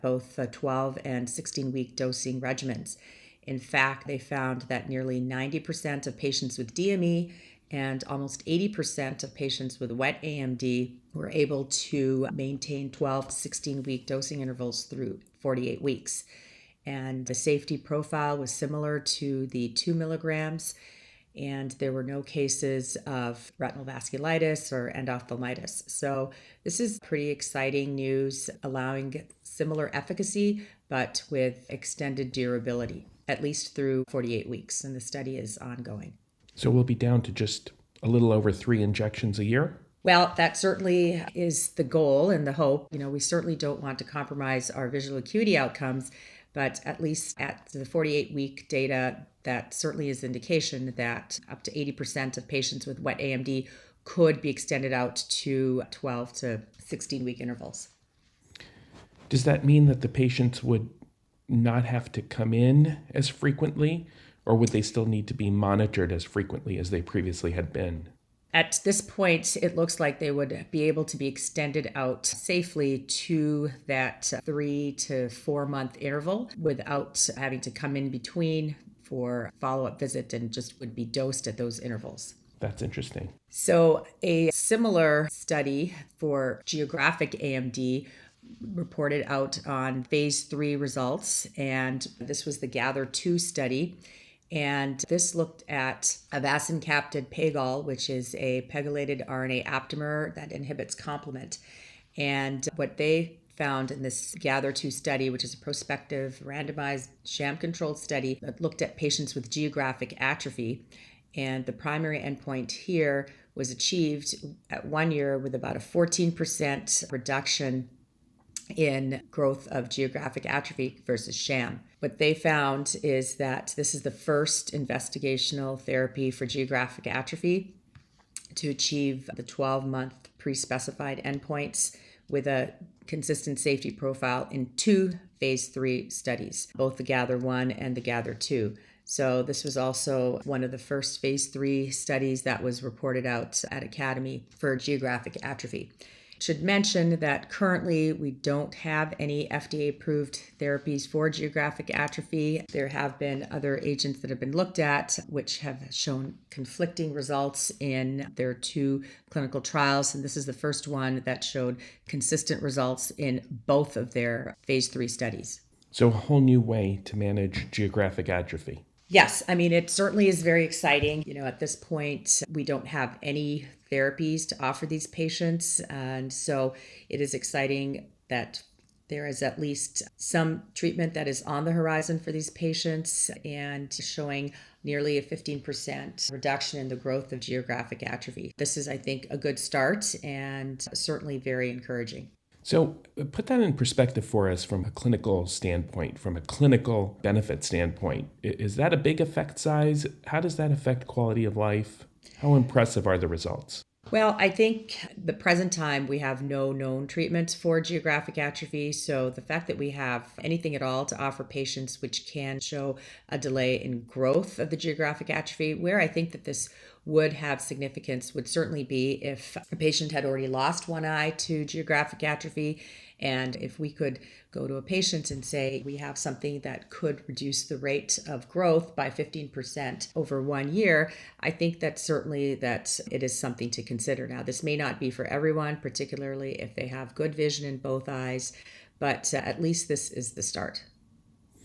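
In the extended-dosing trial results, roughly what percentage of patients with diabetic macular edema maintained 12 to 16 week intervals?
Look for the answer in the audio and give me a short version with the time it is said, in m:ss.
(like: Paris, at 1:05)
90%, at 0:04.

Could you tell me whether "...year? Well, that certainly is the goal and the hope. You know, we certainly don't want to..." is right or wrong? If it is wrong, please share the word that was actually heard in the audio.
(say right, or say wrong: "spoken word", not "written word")
right.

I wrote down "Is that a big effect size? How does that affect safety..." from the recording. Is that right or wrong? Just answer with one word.
wrong.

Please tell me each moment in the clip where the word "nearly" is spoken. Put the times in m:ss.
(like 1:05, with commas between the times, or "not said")
0:04, 3:04.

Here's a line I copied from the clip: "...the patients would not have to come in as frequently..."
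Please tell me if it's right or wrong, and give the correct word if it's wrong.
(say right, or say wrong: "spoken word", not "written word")
right.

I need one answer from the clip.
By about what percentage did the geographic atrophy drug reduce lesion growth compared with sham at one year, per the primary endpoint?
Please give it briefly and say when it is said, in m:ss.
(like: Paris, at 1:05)
14%, at 1:55.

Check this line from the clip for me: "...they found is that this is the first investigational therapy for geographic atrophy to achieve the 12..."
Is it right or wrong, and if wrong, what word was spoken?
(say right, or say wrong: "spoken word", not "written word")
right.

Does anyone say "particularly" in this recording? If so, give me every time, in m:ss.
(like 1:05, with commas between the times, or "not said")
3:55.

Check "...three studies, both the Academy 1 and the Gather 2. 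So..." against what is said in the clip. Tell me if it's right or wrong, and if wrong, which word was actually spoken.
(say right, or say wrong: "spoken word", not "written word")
wrong: "Gather", not "Academy".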